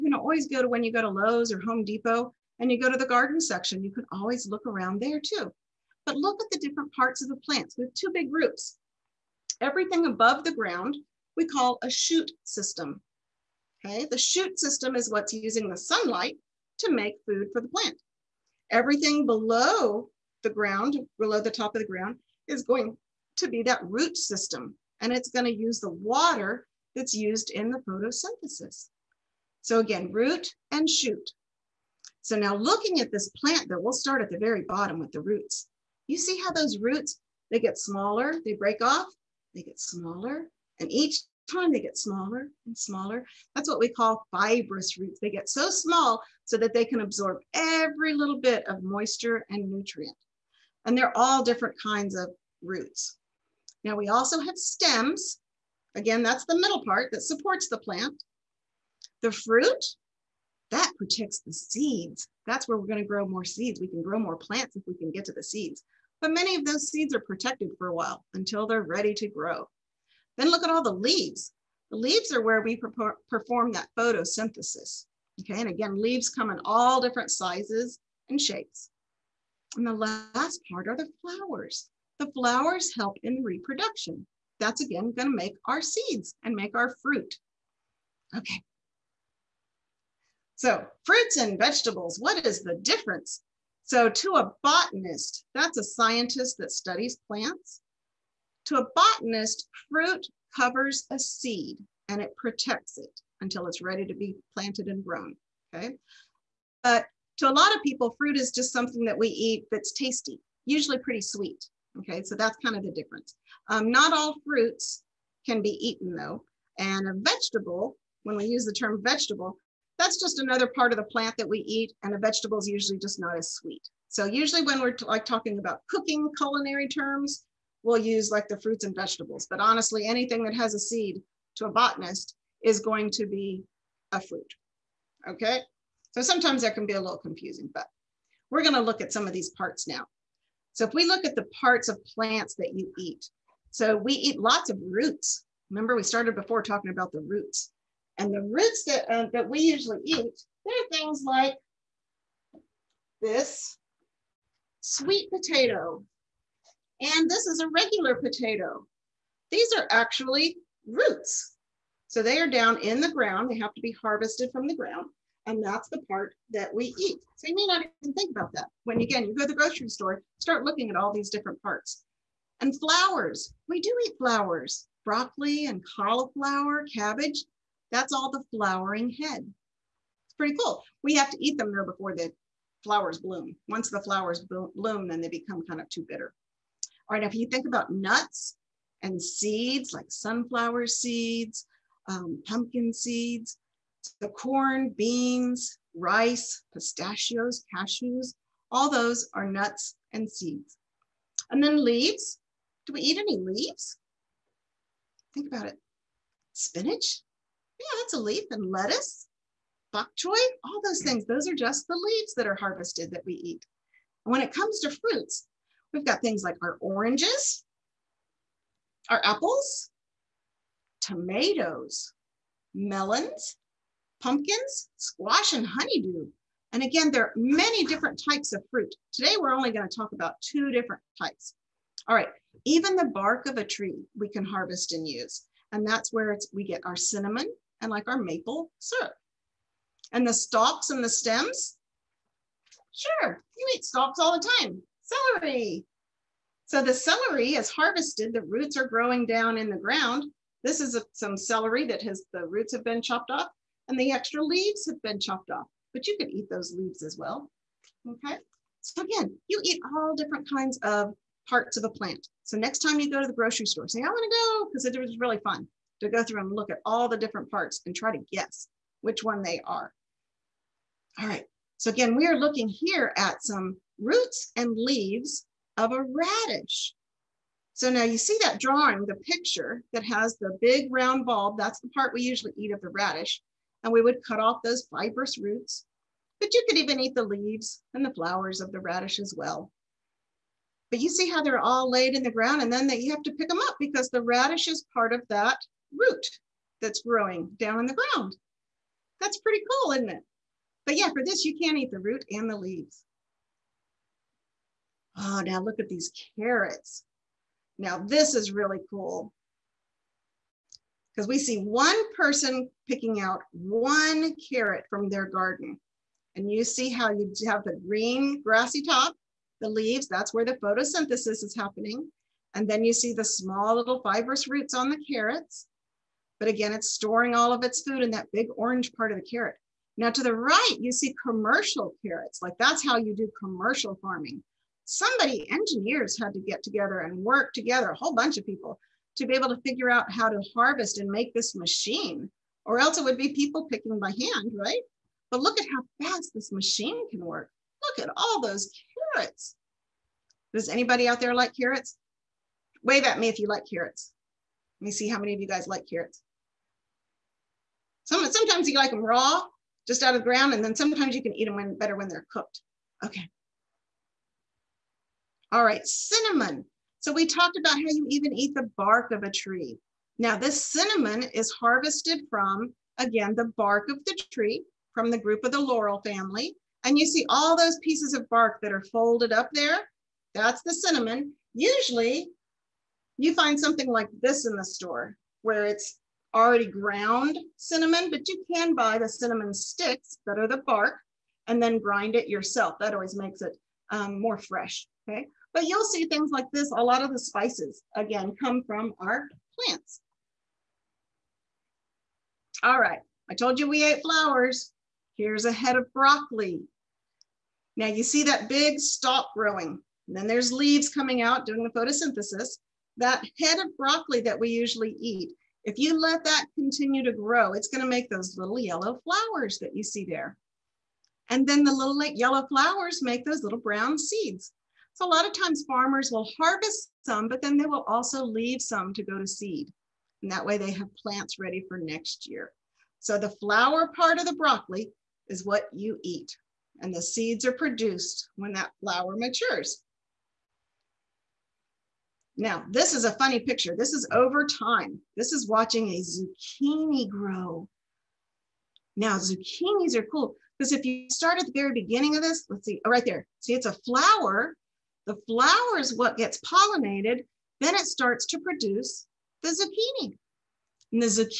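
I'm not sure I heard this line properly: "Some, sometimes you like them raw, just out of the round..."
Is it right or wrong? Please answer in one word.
wrong.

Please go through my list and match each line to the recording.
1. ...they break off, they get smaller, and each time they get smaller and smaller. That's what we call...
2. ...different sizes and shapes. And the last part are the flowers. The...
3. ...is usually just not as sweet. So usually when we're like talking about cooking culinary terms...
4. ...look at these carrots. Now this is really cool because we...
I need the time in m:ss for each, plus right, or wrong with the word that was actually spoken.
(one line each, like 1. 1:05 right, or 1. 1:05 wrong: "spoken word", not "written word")
1. 0:38 right
2. 1:17 right
3. 2:02 right
4. 5:05 right.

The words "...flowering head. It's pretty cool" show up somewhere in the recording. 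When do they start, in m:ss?
2:58.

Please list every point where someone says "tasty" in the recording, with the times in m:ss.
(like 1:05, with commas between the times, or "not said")
1:49.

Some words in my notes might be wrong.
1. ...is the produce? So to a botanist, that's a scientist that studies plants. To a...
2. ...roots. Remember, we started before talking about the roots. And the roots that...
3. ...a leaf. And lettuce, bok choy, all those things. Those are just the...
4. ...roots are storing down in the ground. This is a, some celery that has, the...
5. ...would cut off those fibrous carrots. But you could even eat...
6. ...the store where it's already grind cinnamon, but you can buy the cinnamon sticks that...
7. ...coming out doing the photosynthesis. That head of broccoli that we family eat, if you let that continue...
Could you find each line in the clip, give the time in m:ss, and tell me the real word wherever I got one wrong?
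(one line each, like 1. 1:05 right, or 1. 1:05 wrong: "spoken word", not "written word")
1. 1:32 wrong: "difference", not "produce"
2. 2:24 right
3. 3:28 right
4. 4:08 wrong: "growing", not "storing"
5. 4:44 wrong: "roots", not "carrots"
6. 6:24 wrong: "ground", not "grind"
7. 6:50 wrong: "usually", not "family".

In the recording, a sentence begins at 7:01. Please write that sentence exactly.
And then the little yellow flowers make those little brown seeds.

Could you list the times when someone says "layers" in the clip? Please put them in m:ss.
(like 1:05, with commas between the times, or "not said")
not said.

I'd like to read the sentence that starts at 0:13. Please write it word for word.
Okay, the shoot system is what's using the sunlight to make food for the plant.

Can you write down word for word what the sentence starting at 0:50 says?
And they're all different kinds of roots.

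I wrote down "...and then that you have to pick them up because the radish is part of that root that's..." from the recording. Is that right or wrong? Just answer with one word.
right.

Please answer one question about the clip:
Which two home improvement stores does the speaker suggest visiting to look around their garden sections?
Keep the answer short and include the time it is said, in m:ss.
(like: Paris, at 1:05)
Lowe's or Home Depot, at 0:01.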